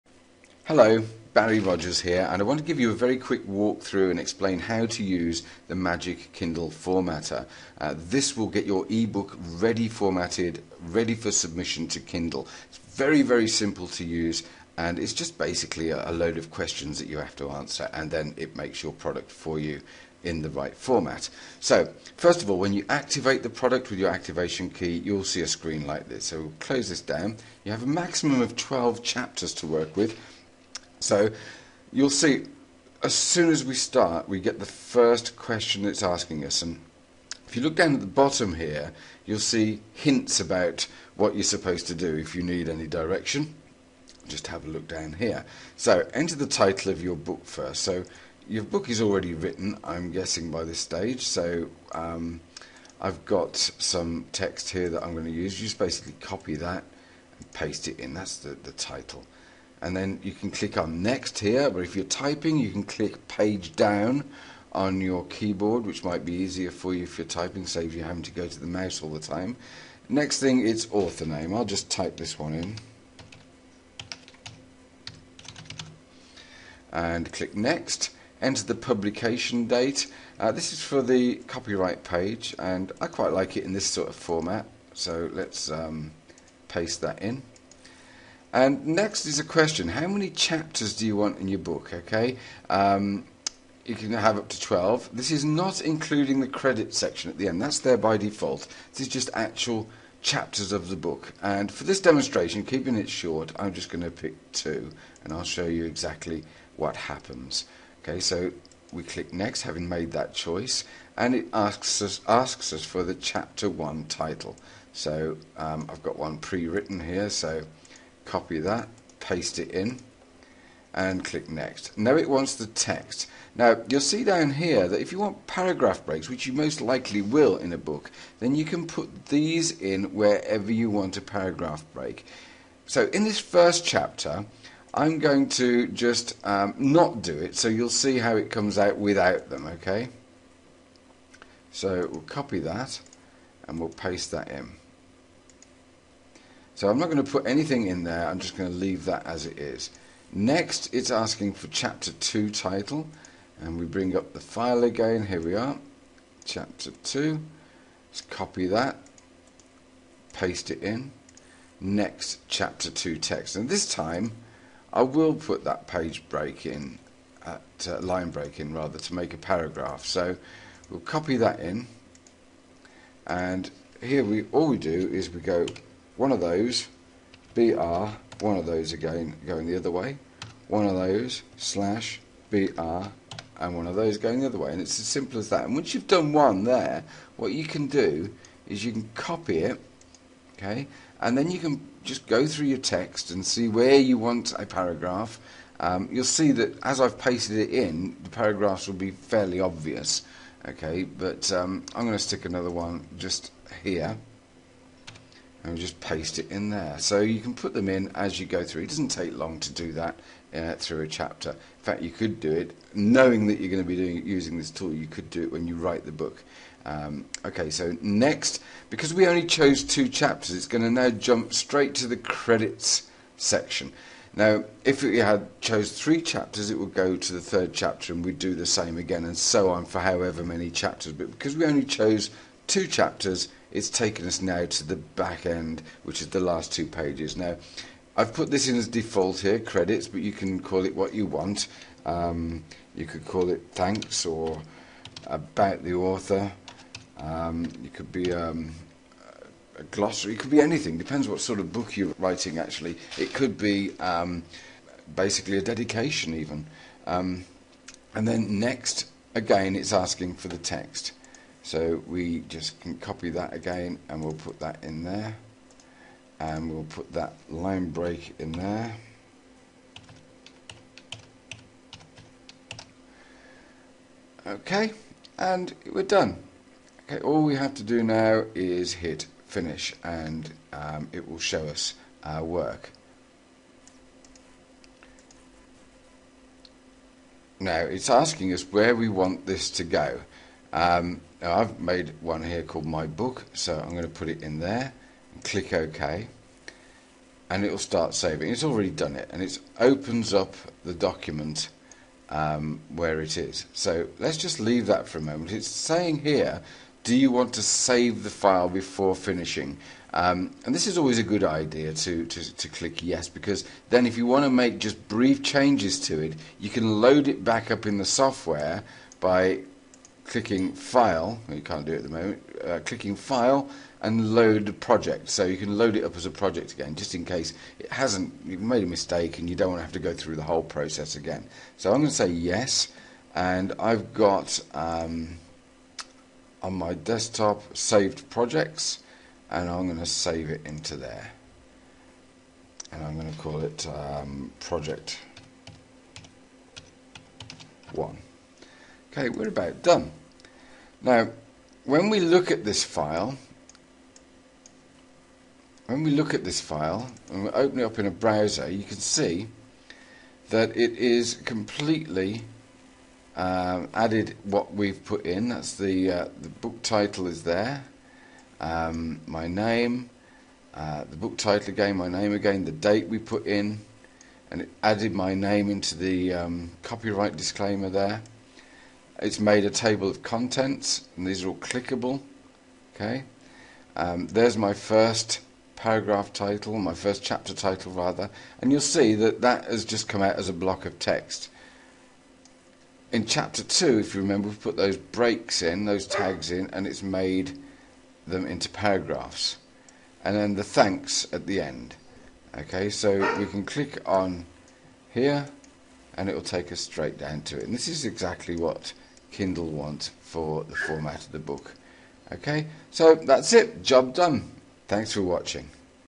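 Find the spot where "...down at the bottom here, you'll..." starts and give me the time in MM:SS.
00:37.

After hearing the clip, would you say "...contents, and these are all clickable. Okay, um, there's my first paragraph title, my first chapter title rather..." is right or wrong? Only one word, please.
right.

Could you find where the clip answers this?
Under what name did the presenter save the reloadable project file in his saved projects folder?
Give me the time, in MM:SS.
05:44.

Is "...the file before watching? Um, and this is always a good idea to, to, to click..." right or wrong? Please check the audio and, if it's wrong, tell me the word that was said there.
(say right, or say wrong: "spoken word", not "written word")
wrong: "finishing", not "watching".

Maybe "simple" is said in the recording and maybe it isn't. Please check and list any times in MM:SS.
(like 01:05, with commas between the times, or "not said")
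00:13, 03:05.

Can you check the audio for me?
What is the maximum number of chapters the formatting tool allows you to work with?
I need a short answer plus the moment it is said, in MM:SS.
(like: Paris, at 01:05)
12, at 00:28.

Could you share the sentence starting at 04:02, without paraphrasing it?
Um, you could call it thanks or about the author.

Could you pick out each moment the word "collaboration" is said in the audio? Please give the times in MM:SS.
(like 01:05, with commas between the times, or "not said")
not said.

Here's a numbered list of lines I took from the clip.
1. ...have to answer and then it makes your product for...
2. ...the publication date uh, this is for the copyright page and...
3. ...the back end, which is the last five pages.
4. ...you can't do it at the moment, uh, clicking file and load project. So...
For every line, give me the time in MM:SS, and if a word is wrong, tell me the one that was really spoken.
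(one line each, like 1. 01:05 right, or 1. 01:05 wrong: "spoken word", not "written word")
1. 00:17 right
2. 01:18 right
3. 03:54 wrong: "two", not "five"
4. 05:21 right.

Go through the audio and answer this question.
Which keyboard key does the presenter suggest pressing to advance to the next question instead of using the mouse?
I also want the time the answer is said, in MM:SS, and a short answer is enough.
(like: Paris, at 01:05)
page down, at 01:03.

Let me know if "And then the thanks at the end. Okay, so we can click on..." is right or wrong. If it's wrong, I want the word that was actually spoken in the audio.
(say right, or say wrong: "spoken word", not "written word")
right.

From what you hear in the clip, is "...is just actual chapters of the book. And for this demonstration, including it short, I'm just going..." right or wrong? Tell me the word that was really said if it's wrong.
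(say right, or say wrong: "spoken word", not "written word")
wrong: "keeping", not "including".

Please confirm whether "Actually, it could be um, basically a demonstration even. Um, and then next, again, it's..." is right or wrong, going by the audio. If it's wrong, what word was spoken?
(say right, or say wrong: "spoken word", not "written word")
wrong: "dedication", not "demonstration".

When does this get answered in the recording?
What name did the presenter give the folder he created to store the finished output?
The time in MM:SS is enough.
04:52.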